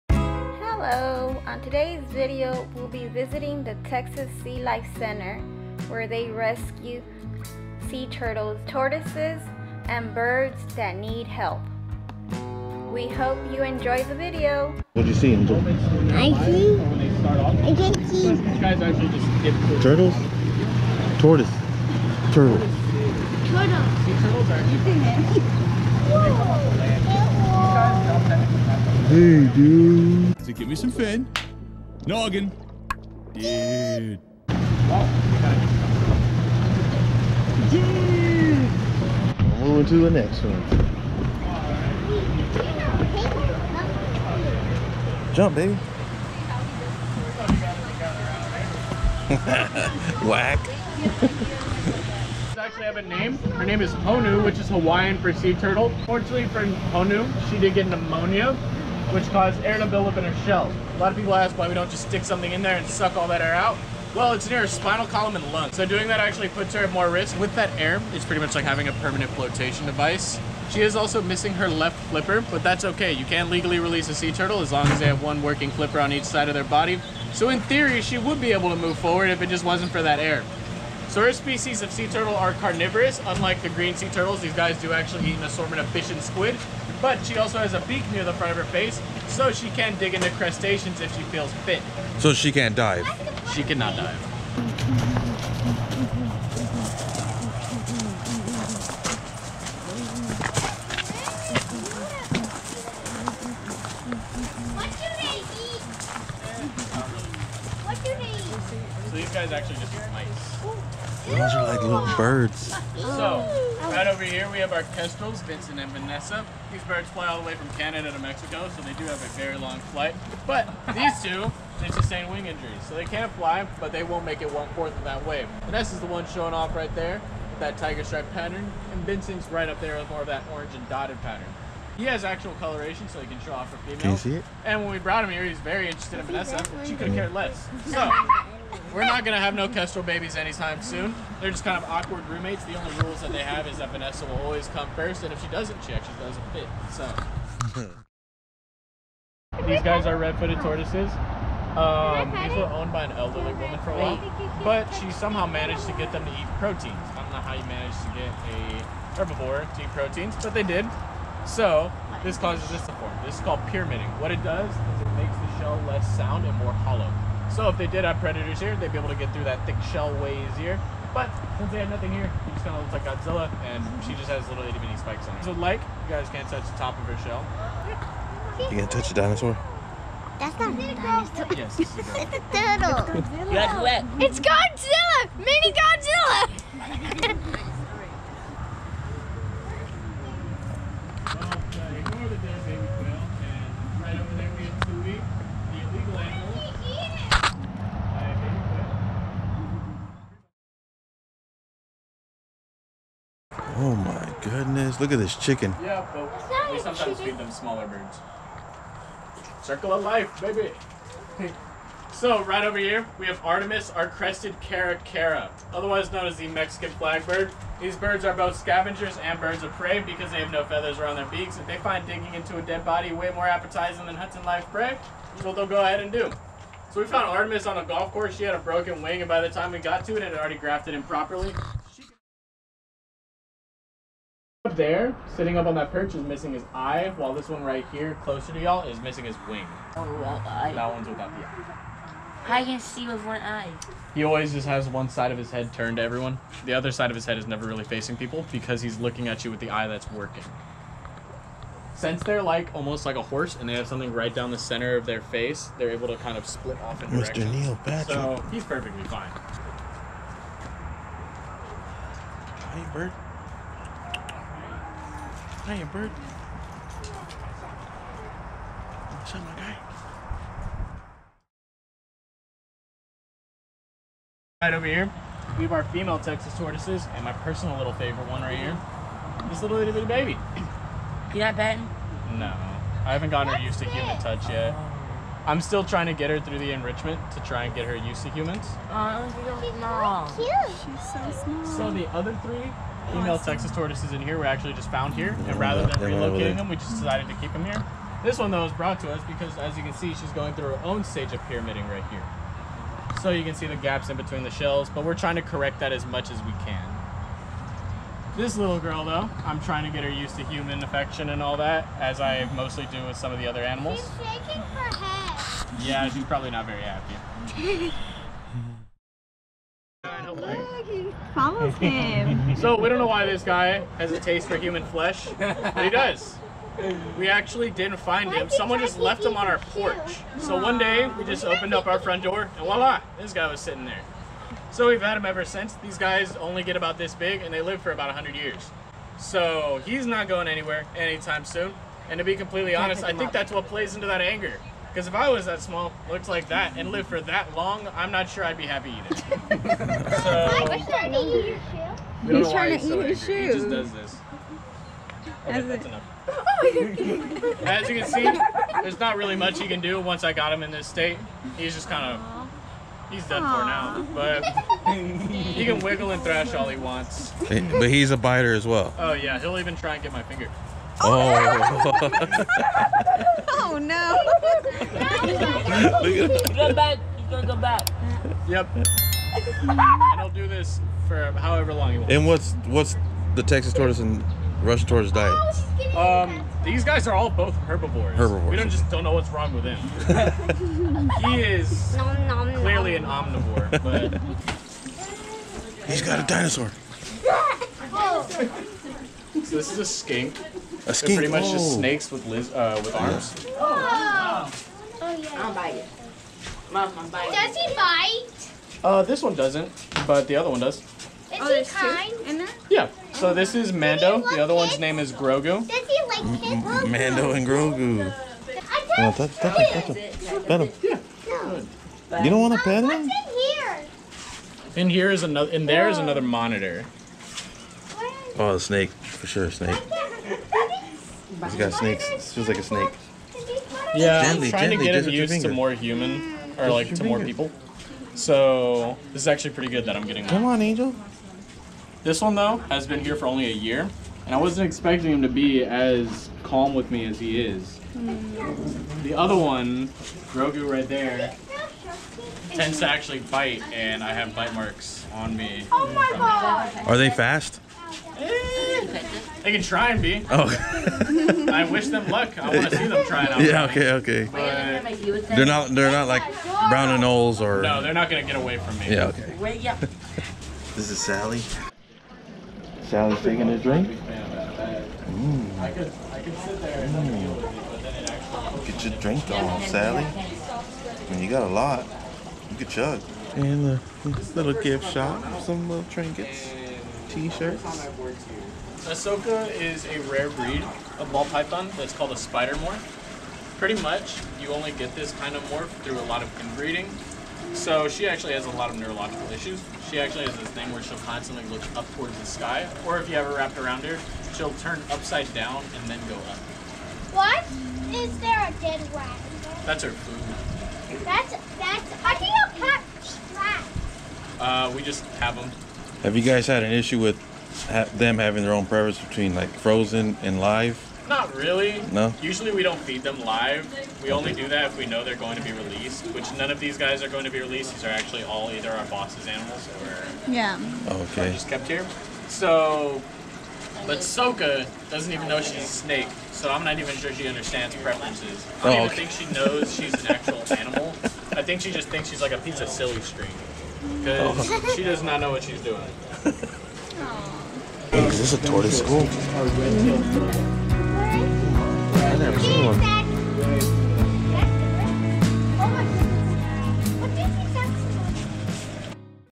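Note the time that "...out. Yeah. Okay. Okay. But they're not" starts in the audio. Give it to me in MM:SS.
07:43.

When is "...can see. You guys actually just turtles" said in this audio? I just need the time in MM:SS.
00:17.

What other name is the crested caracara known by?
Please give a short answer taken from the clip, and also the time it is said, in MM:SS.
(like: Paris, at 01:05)
Mexican flagbird, at 03:36.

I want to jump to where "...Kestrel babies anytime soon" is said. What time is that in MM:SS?
02:19.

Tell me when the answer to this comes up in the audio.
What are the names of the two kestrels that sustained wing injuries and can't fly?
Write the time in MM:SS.
01:55.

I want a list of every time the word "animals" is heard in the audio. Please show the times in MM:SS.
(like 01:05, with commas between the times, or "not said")
05:13, 08:49, 09:00.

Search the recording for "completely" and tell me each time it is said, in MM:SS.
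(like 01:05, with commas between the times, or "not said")
05:42.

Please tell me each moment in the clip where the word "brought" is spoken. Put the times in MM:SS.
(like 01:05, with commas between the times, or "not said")
02:14, 04:58.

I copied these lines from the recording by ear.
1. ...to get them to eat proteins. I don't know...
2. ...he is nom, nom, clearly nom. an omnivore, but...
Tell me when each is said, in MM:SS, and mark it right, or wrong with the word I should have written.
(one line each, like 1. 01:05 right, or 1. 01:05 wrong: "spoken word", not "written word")
1. 02:35 right
2. 06:31 right.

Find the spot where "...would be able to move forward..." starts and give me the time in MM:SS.
01:18.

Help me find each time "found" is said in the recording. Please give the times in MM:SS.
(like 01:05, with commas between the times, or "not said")
03:47, 04:54.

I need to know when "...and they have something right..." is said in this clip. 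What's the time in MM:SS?
04:13.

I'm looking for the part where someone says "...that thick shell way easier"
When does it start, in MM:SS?
02:49.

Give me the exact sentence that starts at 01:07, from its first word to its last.
With that air, it's pretty much like having a permanent flotation device.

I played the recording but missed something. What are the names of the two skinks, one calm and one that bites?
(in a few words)
Mando and Grogu.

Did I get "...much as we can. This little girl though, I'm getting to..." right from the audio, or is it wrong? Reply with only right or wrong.
wrong.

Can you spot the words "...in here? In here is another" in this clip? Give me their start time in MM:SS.
07:03.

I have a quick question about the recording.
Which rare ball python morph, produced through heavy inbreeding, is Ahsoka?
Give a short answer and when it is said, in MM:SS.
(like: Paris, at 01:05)
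spider morph, at 08:12.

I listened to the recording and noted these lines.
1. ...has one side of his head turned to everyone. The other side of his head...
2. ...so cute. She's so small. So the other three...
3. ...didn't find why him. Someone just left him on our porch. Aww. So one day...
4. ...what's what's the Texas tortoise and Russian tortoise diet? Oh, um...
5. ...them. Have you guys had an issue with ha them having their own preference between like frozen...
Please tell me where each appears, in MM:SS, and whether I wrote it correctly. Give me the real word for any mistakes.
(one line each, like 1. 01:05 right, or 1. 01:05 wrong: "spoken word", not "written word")
1. 04:04 right
2. 04:50 right
3. 05:27 right
4. 06:22 right
5. 08:35 right.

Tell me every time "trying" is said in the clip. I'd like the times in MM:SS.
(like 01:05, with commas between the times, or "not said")
04:45, 05:05, 05:09, 05:52, 07:14.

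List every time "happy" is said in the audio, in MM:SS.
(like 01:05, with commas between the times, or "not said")
05:16, 05:48.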